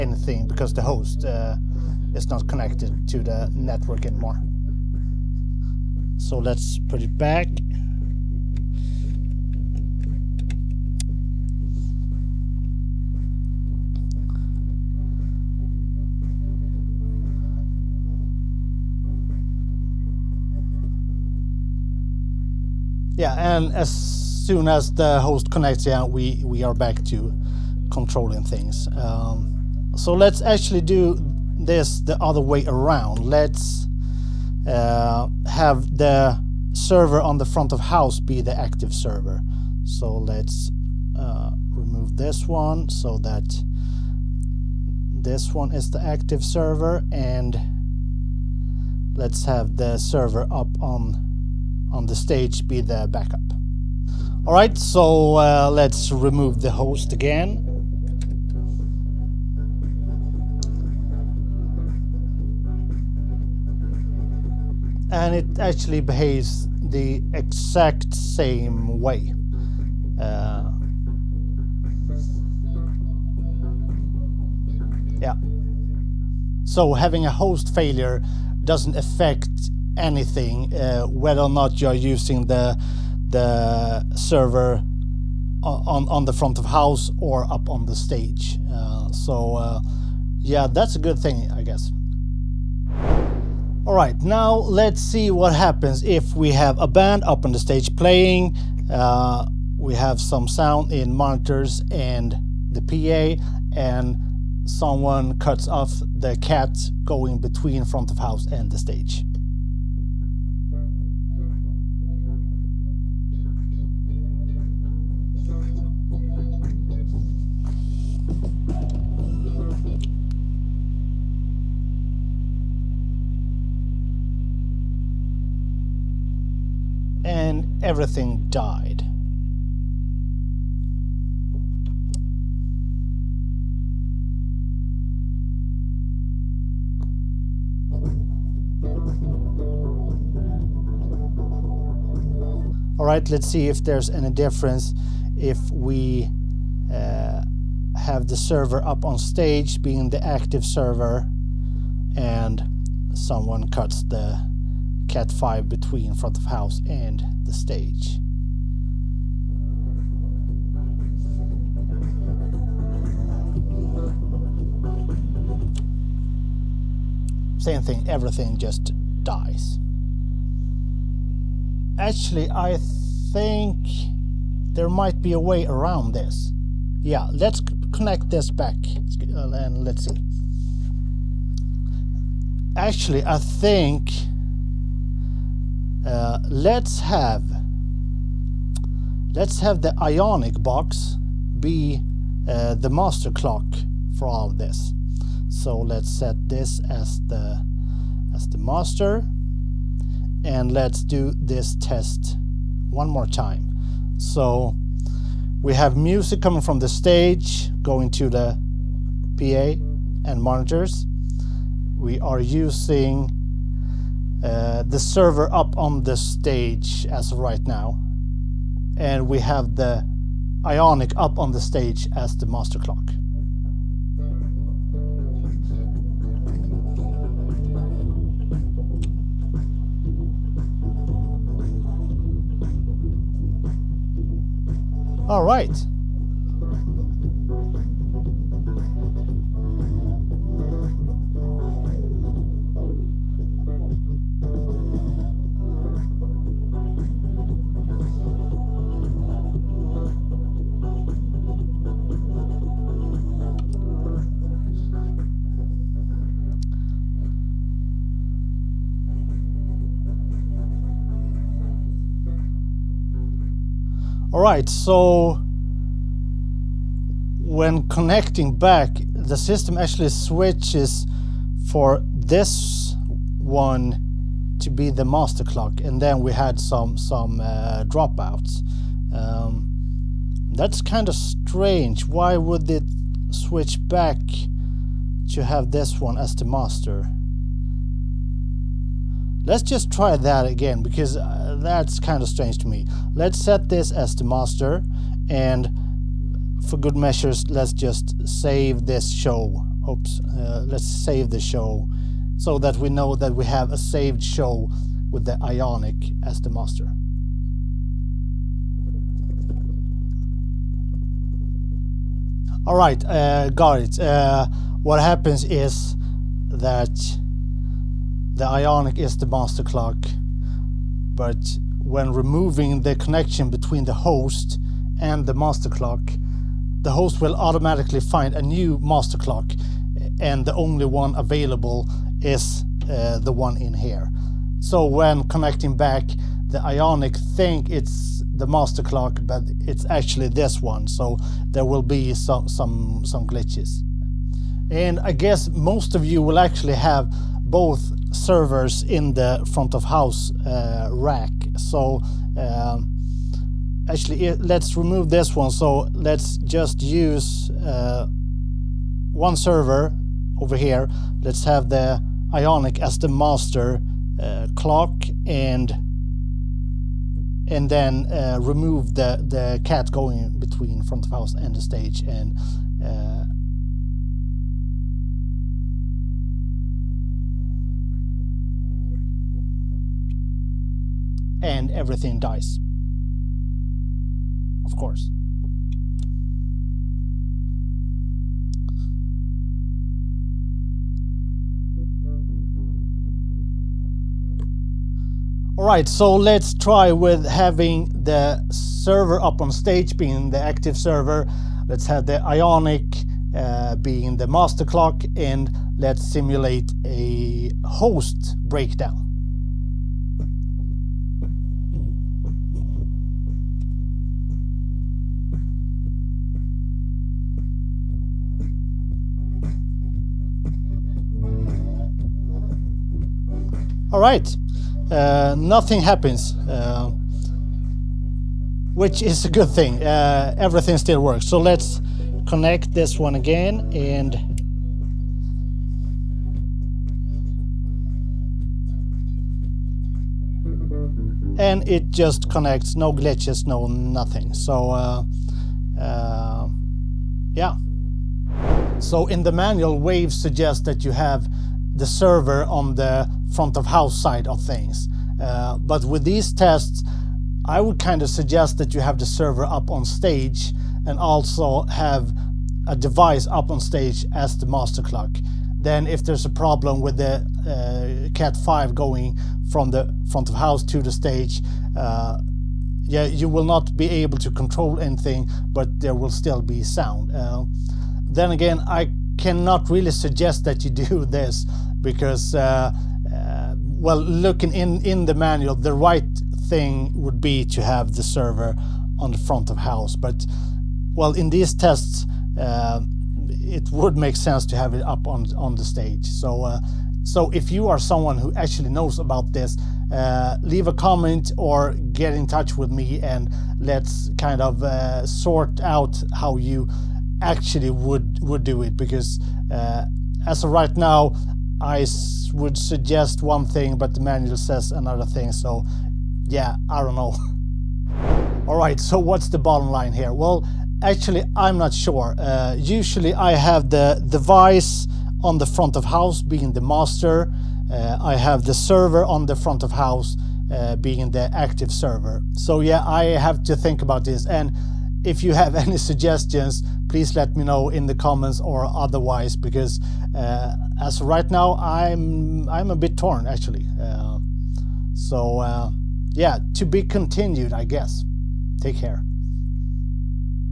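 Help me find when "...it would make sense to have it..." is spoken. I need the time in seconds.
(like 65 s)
493 s.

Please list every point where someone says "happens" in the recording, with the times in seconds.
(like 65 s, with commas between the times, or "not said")
95 s, 315 s, 425 s.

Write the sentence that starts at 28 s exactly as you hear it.
Um, so let's actually do this the other way around.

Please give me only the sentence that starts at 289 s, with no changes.
Let's just try that again because uh, that's kind of strange to me.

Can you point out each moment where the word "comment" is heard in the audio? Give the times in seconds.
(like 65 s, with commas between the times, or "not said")
500 s, 537 s.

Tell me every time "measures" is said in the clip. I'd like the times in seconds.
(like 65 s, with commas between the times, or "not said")
296 s.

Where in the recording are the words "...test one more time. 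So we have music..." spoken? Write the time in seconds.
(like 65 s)
201 s.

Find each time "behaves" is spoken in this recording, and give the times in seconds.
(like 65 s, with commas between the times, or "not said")
65 s.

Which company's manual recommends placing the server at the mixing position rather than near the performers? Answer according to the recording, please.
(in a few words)
Waves.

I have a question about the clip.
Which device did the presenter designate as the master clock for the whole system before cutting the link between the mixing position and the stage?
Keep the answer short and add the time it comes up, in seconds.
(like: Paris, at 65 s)
Ionic box, at 190 s.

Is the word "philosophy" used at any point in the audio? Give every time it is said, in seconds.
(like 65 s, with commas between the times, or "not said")
not said.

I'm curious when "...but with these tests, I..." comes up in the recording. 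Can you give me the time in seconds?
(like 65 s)
455 s.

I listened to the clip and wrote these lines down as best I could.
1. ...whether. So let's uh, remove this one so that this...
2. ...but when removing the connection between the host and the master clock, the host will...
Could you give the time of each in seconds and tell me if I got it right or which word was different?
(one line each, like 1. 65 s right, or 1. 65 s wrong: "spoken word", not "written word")
1. 38 s wrong: "server", not "whether"
2. 321 s right.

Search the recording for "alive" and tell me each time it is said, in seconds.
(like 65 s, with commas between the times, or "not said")
not said.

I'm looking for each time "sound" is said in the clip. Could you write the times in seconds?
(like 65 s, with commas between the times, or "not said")
100 s, 476 s.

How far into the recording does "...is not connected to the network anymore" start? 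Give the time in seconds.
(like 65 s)
2 s.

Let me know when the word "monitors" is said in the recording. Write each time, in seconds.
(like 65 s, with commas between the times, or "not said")
101 s, 210 s.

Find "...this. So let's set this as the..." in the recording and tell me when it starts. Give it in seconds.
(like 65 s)
194 s.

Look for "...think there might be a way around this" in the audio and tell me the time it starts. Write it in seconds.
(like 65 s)
172 s.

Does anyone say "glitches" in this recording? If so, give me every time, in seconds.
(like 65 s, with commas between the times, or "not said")
343 s, 442 s.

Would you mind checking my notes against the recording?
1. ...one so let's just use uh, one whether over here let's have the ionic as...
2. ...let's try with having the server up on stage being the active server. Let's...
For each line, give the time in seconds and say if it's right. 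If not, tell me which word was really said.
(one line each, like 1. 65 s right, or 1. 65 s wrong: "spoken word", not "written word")
1. 355 s wrong: "server", not "whether"
2. 396 s right.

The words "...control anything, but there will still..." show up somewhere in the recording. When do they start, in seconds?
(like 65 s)
474 s.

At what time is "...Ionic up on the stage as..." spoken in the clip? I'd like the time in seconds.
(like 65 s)
220 s.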